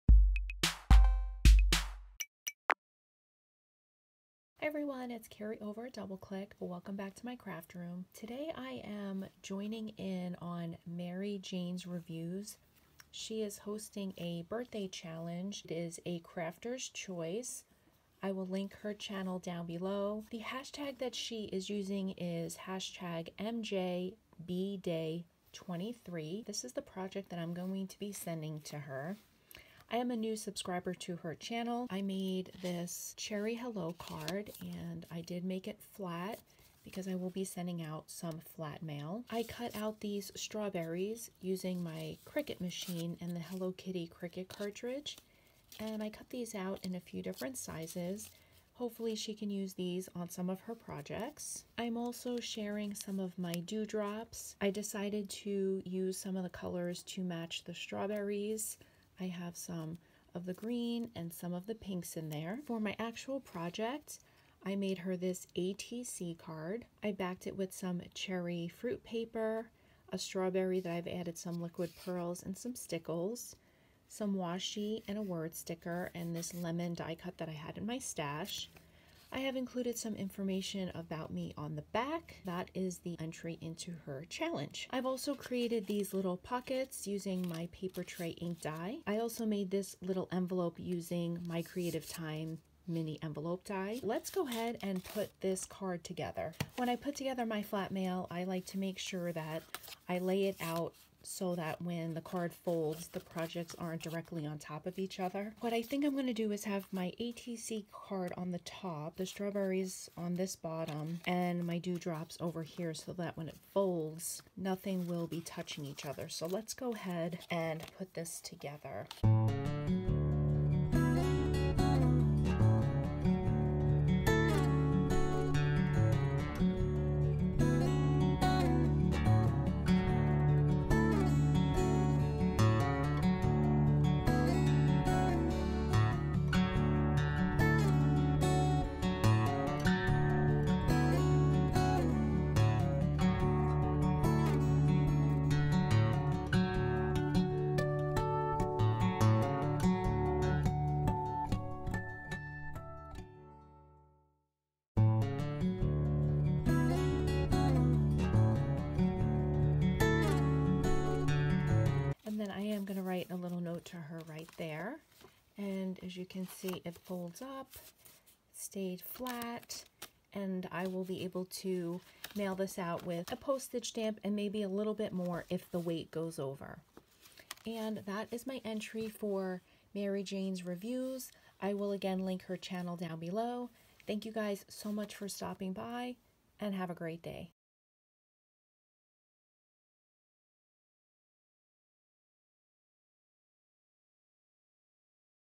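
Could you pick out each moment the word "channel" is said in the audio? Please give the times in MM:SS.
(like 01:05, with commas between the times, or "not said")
00:18, 00:31, 03:02.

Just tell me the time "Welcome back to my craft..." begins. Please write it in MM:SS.
00:06.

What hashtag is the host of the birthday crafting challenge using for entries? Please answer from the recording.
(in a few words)
#MJBDay23.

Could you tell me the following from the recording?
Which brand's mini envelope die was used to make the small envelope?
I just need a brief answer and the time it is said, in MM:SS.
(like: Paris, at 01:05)
Creative Time, at 01:31.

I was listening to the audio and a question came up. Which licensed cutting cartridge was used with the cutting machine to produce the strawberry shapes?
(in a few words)
Hello Kitty.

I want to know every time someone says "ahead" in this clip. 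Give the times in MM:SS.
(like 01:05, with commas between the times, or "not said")
01:34, 01:56.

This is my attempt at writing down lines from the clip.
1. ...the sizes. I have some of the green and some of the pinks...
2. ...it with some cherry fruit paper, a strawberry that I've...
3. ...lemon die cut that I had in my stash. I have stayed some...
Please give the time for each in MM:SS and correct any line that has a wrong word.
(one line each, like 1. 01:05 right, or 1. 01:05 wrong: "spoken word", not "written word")
1. 00:57 wrong: "strawberries", not "sizes"
2. 01:07 right
3. 01:16 wrong: "included", not "stayed".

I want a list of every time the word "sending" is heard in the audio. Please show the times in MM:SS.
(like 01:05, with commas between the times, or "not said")
00:28, 00:37.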